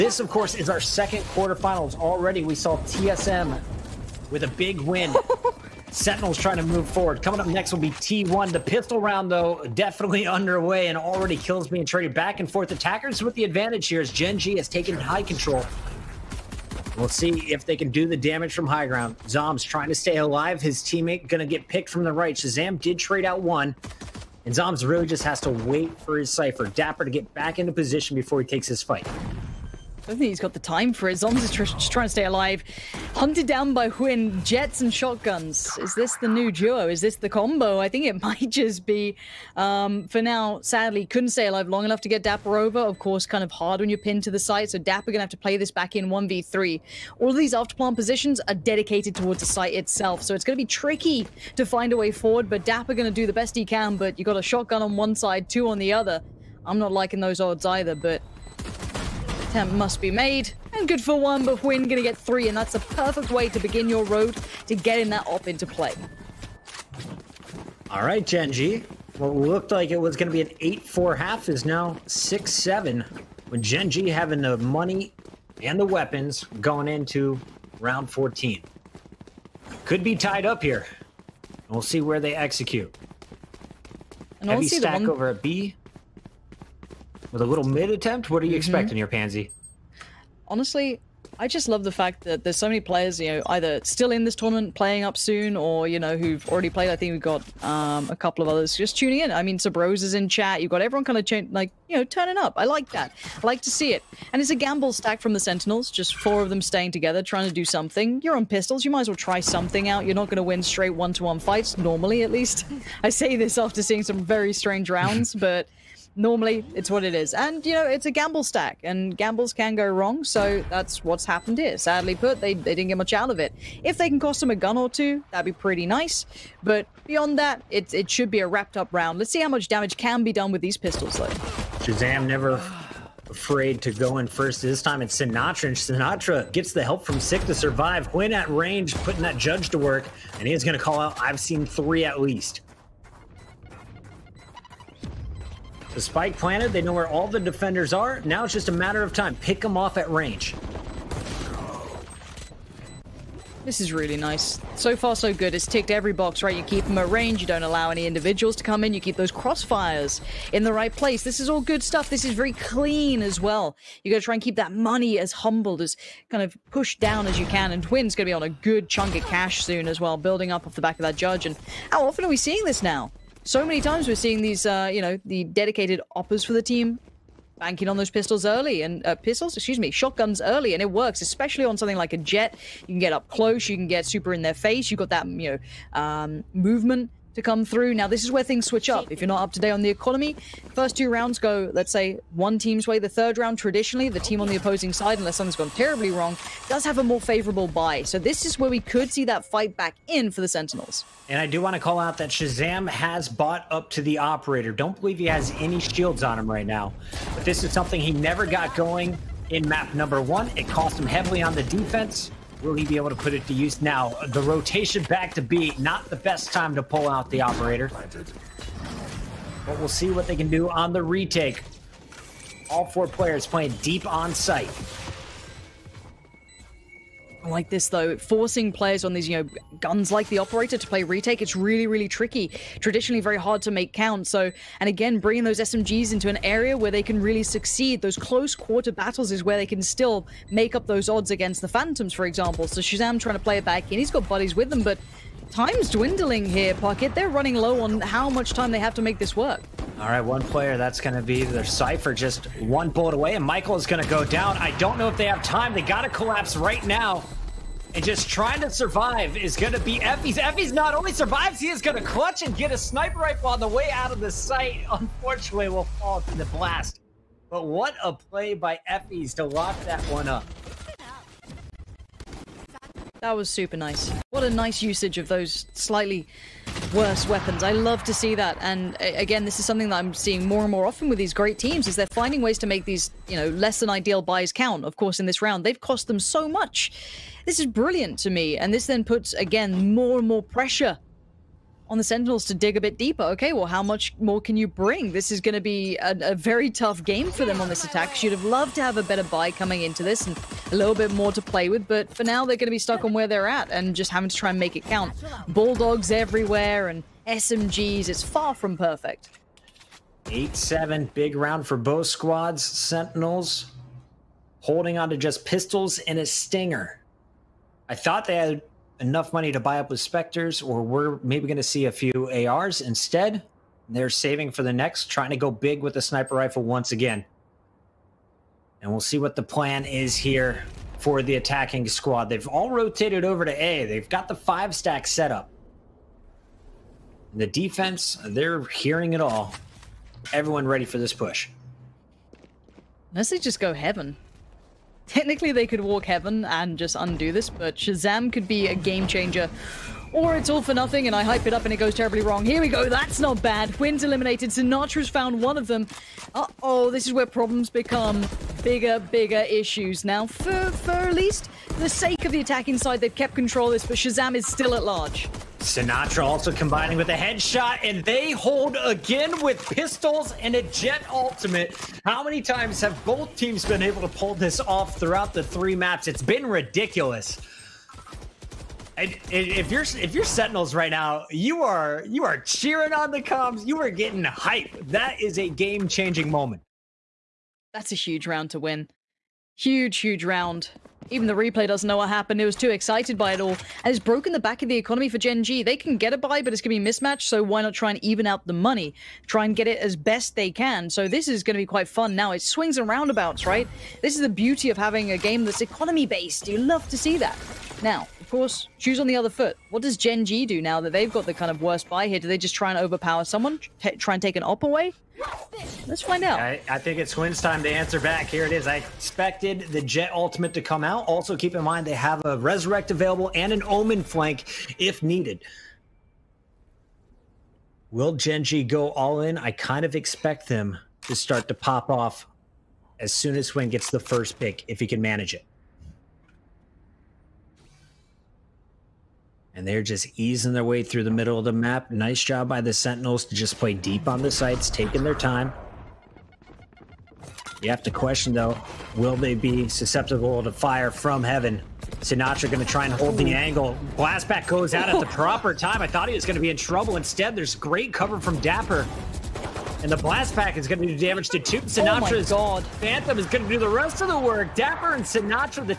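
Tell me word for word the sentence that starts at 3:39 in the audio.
But we'll see what they can do on the retake.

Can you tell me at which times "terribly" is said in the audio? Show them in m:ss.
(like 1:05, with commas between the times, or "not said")
3:15, 5:51.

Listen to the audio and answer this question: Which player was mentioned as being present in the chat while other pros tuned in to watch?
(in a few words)
Sabros.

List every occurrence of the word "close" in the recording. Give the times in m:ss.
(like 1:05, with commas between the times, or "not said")
3:03, 3:58.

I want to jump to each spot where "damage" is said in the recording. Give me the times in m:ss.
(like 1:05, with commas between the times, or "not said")
0:18, 2:09, 7:40.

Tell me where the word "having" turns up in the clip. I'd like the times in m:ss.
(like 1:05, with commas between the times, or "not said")
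1:14, 5:04, 6:44.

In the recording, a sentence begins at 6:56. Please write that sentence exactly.
I, I, think it's Twins time to answer back.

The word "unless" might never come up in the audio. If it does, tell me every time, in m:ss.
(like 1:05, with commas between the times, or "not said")
3:15, 5:43.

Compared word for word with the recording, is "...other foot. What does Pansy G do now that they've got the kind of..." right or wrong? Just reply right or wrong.
wrong.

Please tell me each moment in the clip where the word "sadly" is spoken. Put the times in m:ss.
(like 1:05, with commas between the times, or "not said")
0:40, 2:01.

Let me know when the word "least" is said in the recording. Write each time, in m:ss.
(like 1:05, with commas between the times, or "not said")
1:52, 2:22, 6:01.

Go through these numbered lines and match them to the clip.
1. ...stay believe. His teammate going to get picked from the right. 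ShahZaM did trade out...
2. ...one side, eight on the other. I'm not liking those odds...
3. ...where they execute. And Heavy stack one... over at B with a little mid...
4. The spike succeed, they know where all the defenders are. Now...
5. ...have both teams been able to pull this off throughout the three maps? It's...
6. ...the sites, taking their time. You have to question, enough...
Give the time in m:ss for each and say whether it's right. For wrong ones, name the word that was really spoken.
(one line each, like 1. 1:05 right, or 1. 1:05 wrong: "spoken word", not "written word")
1. 0:19 wrong: "alive", not "believe"
2. 0:54 wrong: "two", not "eight"
3. 1:22 right
4. 2:25 wrong: "planted", not "succeed"
5. 6:12 right
6. 7:24 wrong: "though", not "enough".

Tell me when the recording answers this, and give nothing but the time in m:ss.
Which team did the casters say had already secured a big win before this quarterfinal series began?
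0:02.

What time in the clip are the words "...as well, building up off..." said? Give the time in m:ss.
2:49.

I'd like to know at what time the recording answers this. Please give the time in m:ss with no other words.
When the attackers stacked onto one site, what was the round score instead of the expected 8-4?
1:12.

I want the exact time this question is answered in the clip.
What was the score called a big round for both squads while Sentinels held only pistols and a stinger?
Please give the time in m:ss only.
5:10.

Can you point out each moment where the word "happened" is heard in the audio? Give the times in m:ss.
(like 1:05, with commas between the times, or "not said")
2:01, 6:32.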